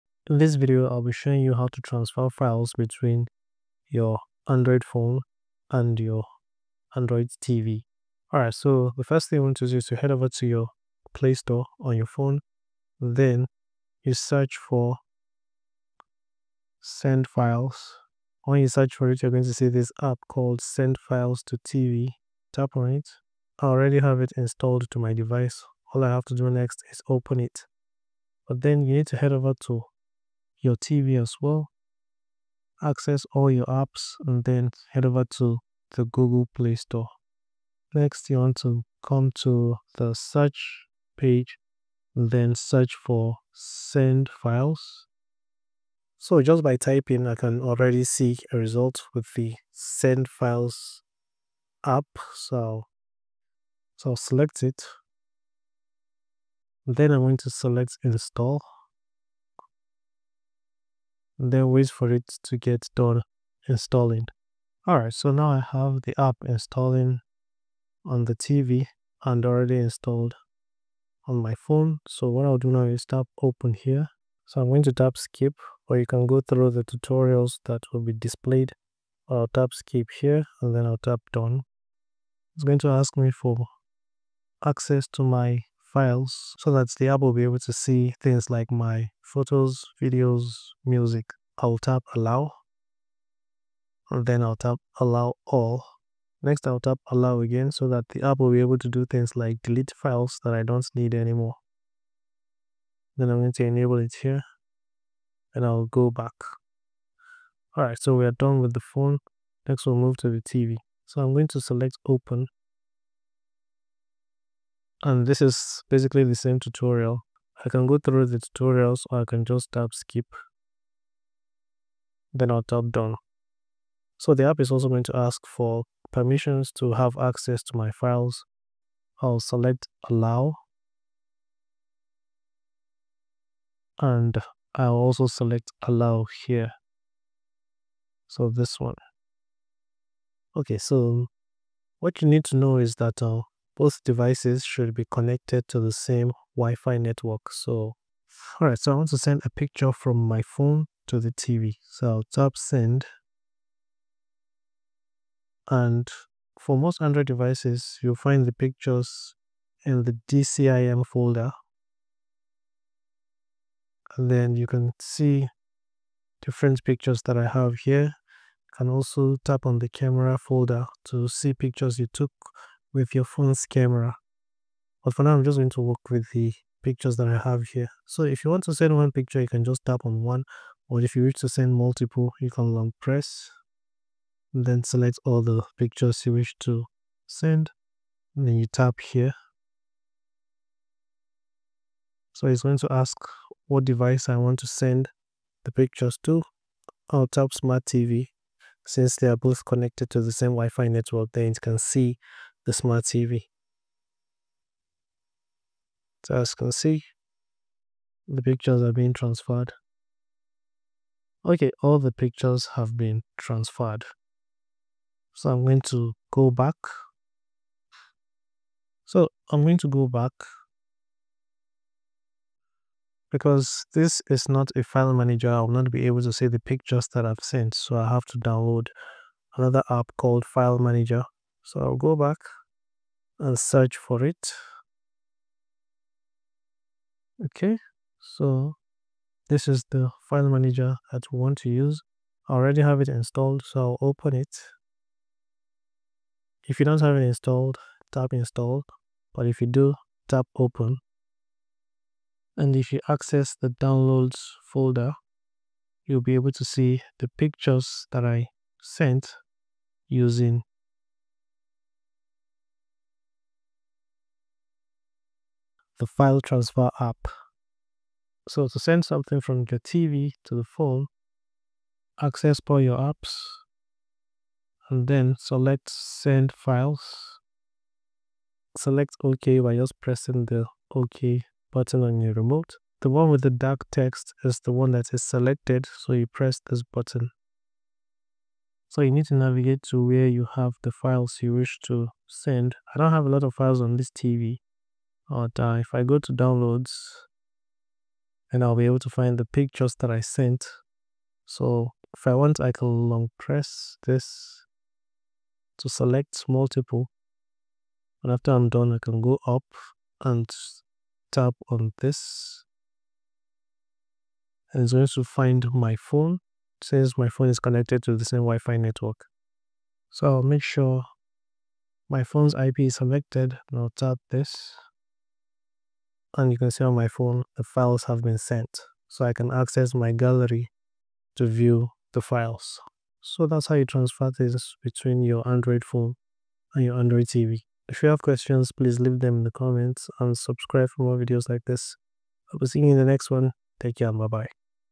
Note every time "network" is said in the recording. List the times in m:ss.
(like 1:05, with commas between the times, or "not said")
2:26, 3:20, 5:18.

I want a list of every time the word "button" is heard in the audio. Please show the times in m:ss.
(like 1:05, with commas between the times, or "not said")
4:41, 4:46.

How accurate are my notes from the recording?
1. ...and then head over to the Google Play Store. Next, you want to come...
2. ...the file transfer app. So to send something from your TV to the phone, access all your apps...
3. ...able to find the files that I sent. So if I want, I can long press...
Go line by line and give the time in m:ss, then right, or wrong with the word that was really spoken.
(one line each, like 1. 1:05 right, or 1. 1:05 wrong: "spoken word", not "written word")
1. 0:34 right
2. 4:26 right
3. 4:58 wrong: "pictures", not "files".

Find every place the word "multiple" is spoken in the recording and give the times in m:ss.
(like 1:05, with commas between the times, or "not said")
3:01, 5:06.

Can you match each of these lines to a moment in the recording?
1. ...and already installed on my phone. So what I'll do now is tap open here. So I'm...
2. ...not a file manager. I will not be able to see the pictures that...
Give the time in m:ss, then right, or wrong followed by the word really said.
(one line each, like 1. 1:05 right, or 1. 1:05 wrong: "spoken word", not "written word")
1. 1:09 right
2. 3:44 right.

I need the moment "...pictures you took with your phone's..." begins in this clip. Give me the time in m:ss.
2:51.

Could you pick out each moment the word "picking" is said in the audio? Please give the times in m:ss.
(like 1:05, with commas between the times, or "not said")
not said.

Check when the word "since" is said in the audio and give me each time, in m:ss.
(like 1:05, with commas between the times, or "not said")
3:18, 5:16.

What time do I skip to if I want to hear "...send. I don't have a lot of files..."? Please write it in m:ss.
4:52.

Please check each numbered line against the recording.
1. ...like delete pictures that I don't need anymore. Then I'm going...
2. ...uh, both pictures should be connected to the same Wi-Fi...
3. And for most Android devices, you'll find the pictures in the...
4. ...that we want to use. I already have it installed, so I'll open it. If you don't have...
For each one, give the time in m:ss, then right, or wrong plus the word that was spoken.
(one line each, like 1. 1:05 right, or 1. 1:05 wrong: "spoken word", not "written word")
1. 1:39 wrong: "files", not "pictures"
2. 2:23 wrong: "devices", not "pictures"
3. 2:35 right
4. 4:01 right.